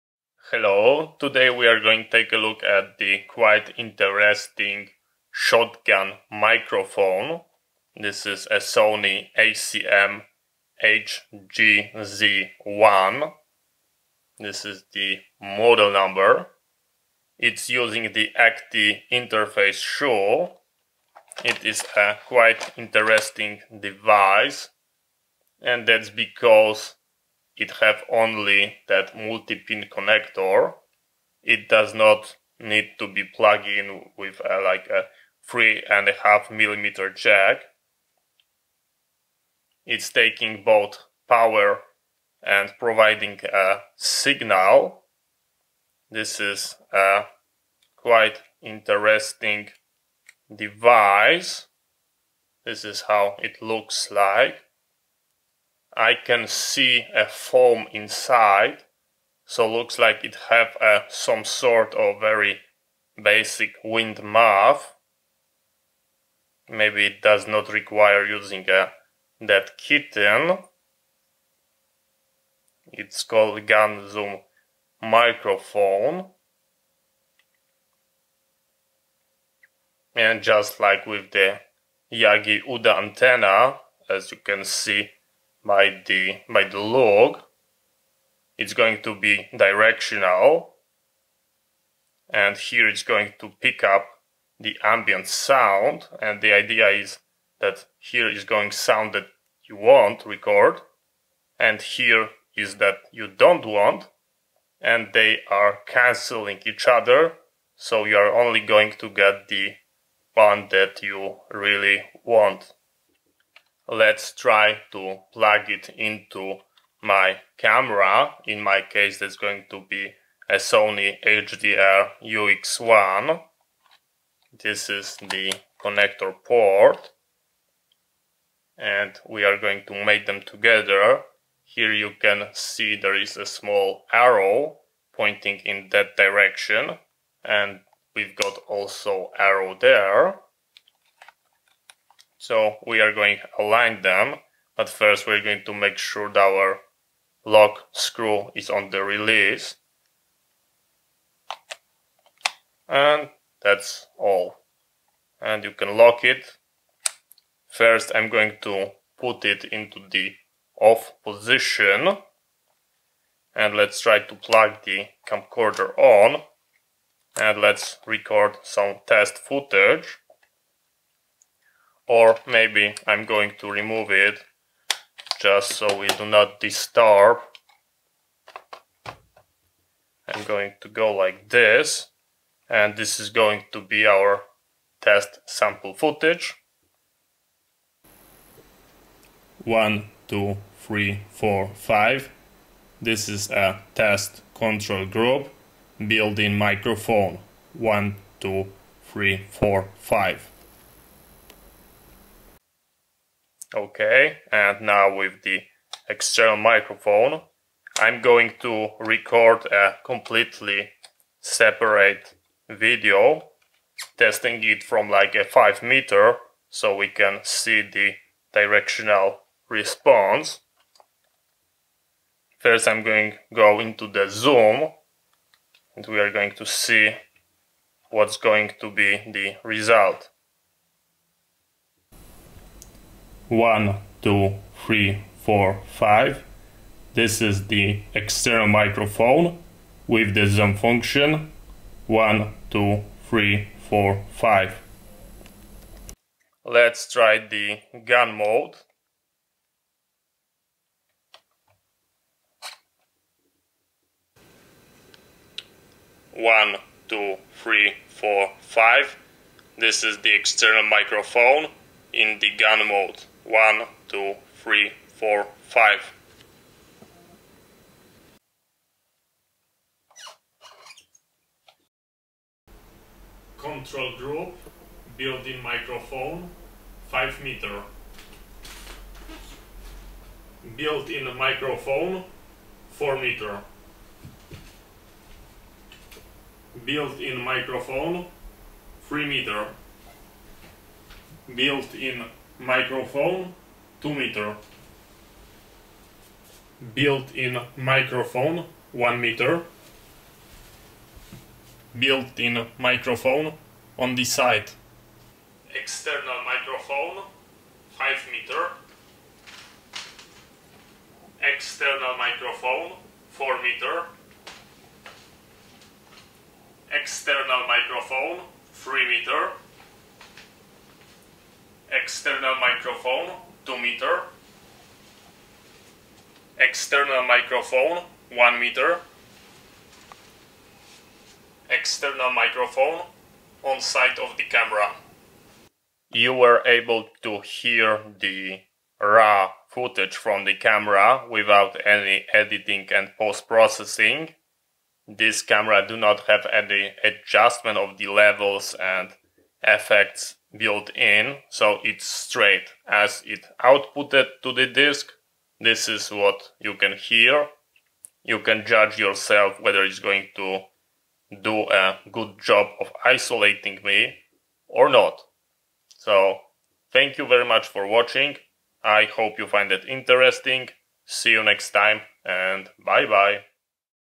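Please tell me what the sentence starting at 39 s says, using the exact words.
It's taking both power and providing a signal.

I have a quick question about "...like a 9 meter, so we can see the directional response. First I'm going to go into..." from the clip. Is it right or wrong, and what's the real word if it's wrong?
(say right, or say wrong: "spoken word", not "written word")
wrong: "5", not "9".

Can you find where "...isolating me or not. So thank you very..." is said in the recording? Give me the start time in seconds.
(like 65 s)
363 s.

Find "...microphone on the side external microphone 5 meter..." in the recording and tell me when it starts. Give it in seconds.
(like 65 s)
302 s.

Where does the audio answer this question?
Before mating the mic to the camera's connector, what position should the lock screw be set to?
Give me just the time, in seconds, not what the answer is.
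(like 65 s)
149 s.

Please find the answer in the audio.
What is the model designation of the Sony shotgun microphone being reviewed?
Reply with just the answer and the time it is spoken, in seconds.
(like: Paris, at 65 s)
ECM HGZ1, at 9 s.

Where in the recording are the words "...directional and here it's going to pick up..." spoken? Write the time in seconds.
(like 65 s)
89 s.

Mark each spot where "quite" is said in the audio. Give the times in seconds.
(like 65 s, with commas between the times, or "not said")
3 s, 22 s, 47 s.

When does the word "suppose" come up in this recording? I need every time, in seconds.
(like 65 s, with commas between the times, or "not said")
not said.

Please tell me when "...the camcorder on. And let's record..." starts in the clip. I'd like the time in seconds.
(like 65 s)
164 s.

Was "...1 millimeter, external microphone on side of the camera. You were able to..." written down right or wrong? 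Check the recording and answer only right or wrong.
wrong.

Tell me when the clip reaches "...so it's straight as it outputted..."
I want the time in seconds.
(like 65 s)
351 s.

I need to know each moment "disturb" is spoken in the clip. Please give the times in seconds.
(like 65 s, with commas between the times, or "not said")
176 s.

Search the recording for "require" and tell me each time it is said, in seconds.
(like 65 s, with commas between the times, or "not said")
67 s.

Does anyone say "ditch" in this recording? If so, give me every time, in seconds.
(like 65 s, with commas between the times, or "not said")
not said.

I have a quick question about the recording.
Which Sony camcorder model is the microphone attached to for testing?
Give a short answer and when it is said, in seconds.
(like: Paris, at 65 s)
Sony HDR UX1, at 120 s.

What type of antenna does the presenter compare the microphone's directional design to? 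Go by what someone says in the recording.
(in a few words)
Yagi Uda.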